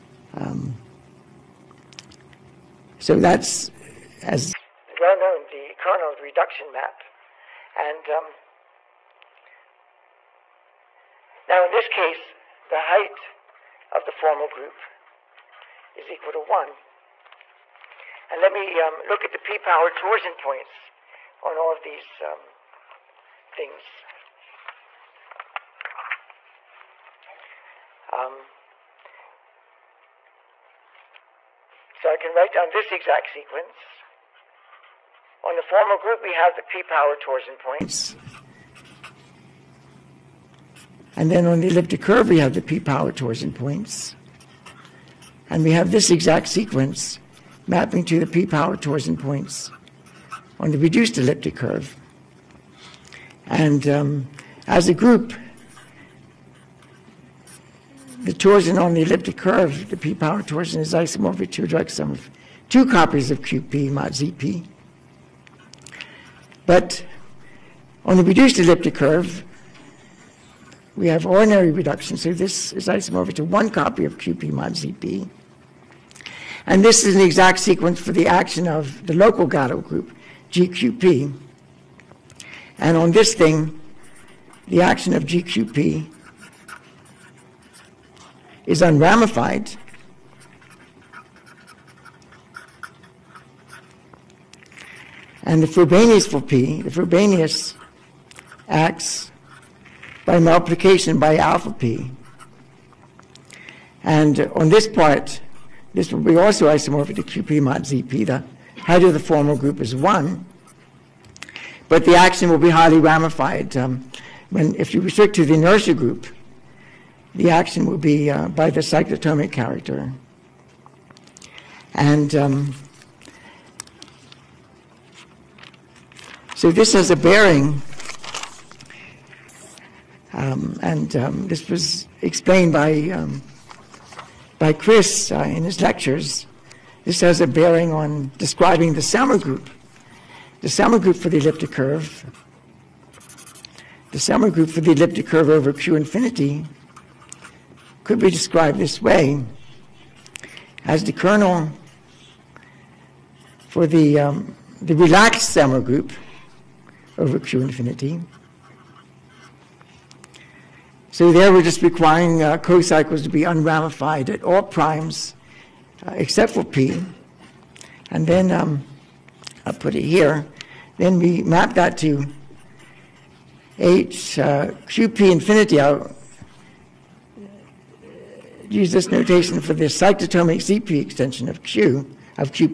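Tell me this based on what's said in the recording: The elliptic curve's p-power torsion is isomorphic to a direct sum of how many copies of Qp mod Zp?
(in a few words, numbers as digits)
two.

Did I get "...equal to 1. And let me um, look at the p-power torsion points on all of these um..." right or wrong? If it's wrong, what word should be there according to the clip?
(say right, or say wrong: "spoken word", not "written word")
right.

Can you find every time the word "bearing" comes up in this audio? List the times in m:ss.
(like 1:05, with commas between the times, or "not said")
2:07, 2:17.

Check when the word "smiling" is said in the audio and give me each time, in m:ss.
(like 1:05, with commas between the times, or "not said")
not said.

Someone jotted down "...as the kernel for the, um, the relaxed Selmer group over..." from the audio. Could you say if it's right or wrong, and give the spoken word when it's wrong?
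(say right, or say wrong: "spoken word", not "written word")
right.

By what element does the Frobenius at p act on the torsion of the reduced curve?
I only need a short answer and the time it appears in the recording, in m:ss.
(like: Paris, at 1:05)
alpha p, at 1:41.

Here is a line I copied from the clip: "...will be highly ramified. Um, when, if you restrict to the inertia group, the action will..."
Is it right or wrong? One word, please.
right.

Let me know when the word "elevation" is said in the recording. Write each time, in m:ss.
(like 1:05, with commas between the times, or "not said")
not said.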